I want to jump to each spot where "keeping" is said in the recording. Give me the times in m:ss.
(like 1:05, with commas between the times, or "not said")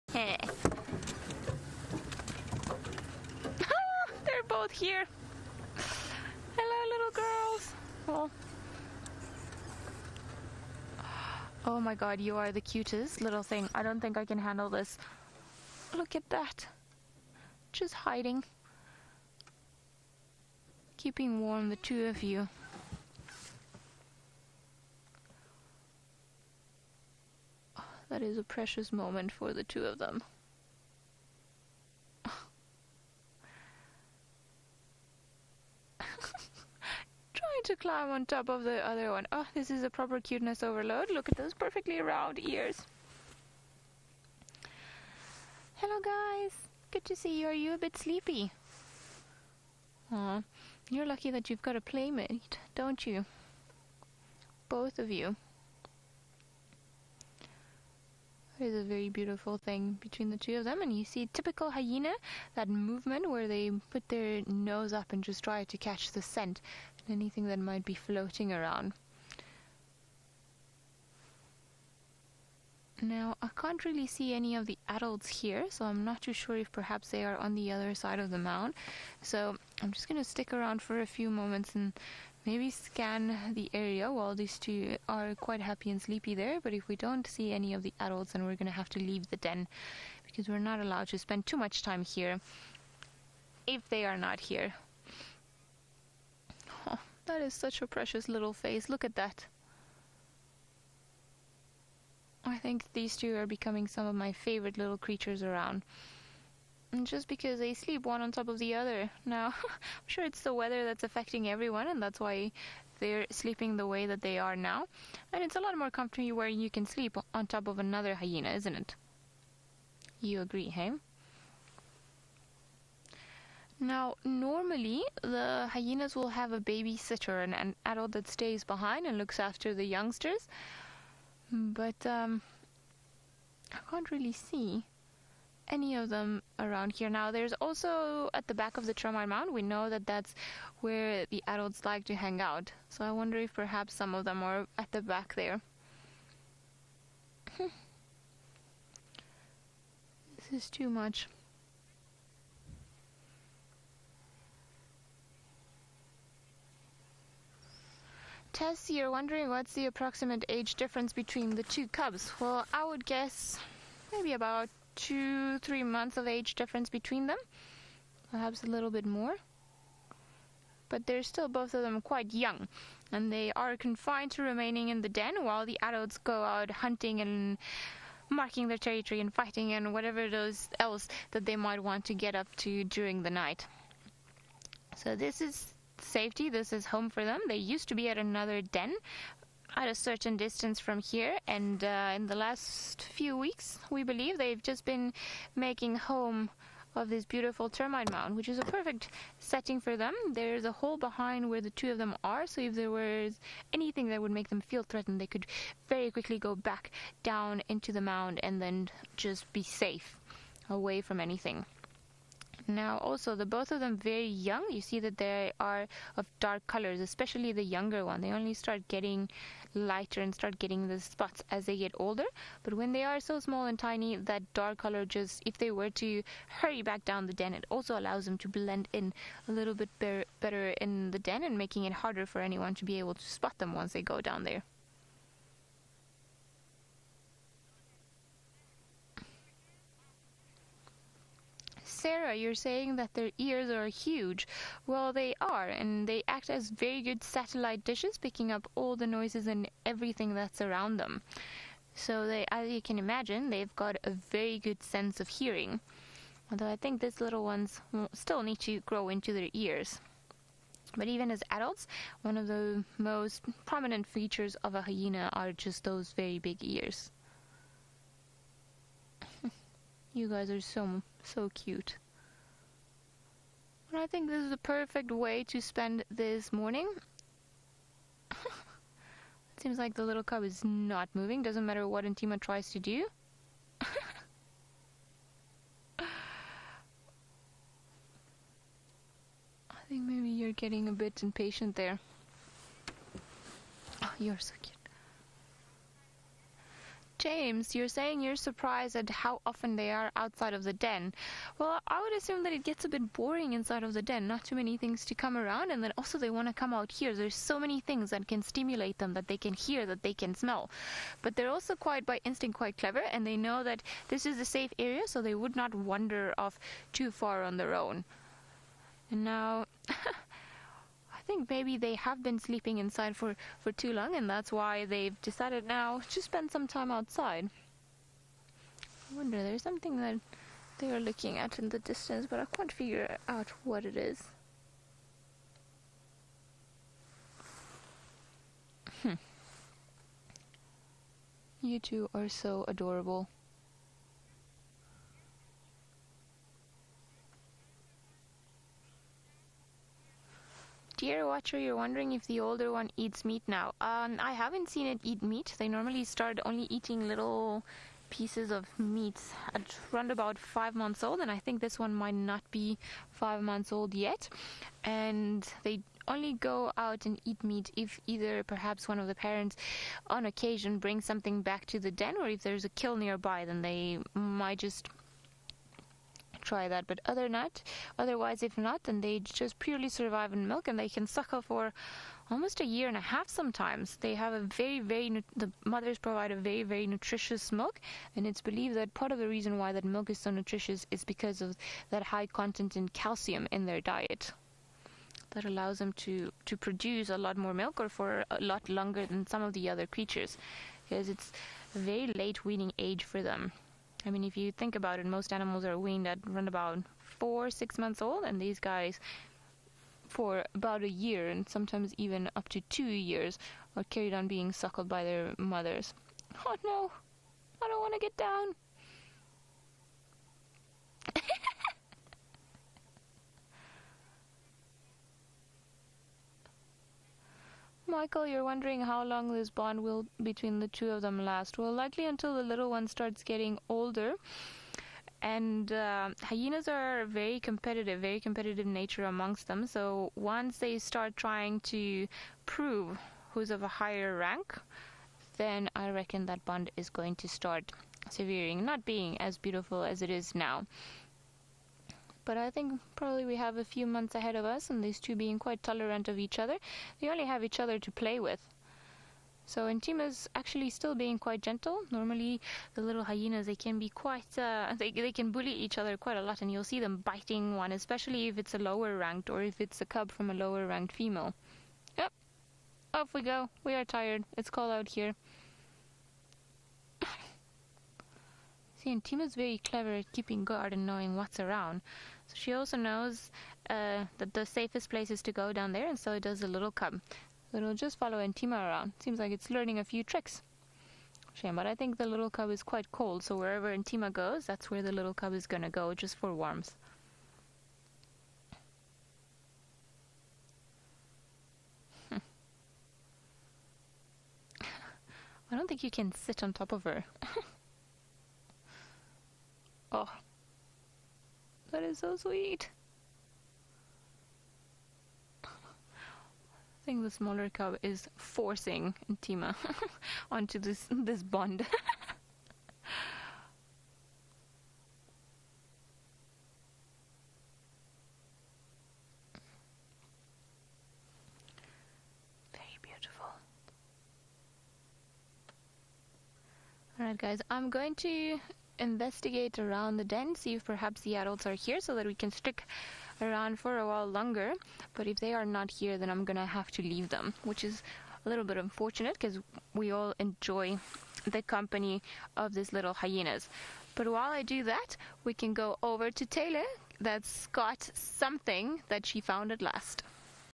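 0:20, 8:00.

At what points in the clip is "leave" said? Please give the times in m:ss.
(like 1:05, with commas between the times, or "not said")
1:28, 9:06.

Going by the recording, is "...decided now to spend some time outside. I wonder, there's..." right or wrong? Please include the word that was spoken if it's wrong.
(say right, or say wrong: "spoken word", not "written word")
right.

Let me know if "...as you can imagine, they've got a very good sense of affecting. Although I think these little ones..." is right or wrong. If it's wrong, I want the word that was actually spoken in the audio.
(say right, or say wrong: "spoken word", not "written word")
wrong: "hearing", not "affecting".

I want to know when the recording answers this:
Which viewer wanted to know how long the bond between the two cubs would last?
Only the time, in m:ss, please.
7:07.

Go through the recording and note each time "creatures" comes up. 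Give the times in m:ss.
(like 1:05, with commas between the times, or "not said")
1:44, 6:39.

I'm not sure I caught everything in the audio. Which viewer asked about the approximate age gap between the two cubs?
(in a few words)
Tess.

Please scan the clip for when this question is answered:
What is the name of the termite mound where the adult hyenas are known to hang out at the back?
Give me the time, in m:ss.
2:18.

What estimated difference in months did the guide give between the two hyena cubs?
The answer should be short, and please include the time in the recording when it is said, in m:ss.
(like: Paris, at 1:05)
2-3 months, at 2:44.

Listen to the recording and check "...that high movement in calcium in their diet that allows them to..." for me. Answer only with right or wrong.
wrong.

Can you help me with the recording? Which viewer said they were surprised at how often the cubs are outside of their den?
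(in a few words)
James.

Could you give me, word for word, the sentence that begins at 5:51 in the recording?
Dear watcher, you're wondering if the older one eats meat now.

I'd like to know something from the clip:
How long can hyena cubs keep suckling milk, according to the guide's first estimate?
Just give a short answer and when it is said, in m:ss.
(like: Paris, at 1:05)
A year and a half, at 6:22.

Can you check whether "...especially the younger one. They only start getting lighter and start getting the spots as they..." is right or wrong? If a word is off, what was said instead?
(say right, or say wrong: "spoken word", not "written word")
right.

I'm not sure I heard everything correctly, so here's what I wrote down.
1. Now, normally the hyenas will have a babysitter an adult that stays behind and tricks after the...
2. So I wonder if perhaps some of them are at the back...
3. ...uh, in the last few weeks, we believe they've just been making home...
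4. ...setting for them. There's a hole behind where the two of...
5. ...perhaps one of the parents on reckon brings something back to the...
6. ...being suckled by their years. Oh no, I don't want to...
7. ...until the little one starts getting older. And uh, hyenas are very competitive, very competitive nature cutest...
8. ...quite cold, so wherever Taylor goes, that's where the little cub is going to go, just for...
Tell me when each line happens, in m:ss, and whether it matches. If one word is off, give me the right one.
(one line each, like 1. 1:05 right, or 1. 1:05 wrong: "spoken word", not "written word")
1. 2:03 wrong: "looks", not "tricks"
2. 2:22 right
3. 3:11 right
4. 3:19 right
5. 6:08 wrong: "occasion", not "reckon"
6. 6:54 wrong: "mothers", not "years"
7. 7:12 wrong: "amongst", not "cutest"
8. 8:12 wrong: "Antima", not "Taylor".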